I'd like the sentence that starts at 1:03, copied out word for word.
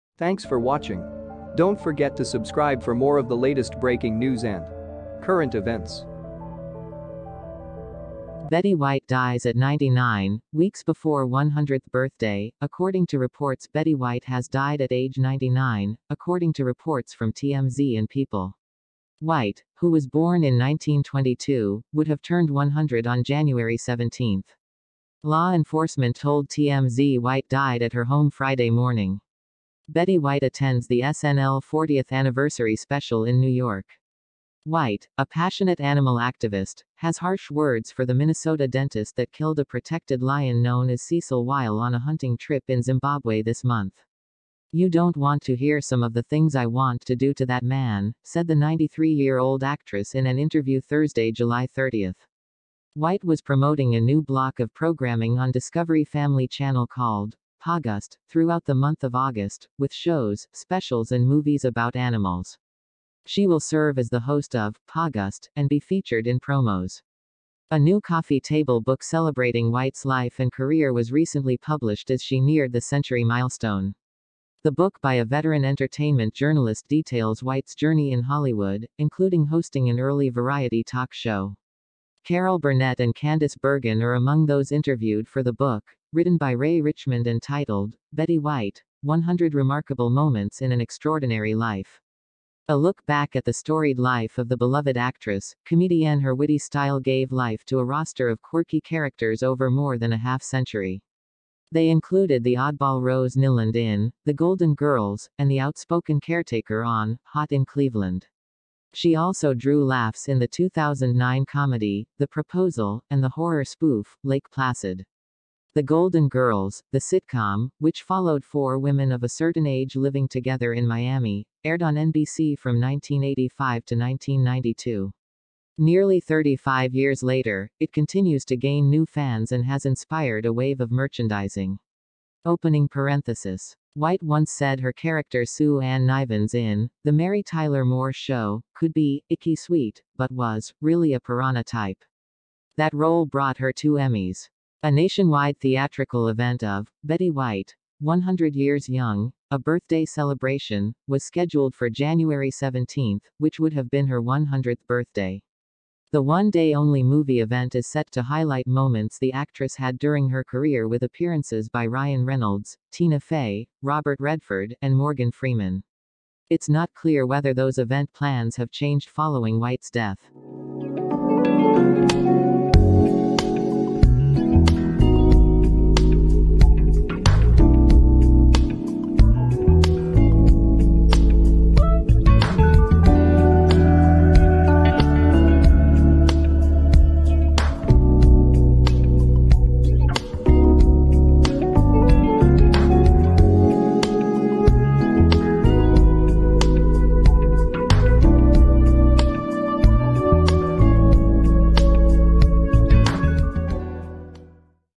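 She will serve as the host of August and be featured in promos.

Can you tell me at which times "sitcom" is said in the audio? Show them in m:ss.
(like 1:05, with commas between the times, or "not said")
1:56.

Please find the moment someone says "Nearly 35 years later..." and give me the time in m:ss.
2:05.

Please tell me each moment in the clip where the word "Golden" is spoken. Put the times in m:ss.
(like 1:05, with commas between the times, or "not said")
1:44, 1:55.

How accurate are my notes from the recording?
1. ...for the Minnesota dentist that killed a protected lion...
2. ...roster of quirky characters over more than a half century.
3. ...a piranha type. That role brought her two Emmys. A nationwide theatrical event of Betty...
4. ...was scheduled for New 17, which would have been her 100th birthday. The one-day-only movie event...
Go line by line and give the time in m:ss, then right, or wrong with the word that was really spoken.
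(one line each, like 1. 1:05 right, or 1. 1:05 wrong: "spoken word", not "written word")
1. 0:37 right
2. 1:37 right
3. 2:21 right
4. 2:31 wrong: "January", not "New".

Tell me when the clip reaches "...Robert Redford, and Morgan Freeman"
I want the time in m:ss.
2:43.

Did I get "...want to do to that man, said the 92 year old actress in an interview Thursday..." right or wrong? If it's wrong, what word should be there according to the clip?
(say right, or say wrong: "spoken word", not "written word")
wrong: "93", not "92".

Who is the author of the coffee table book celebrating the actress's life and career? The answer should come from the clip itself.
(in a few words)
Ray Richmond.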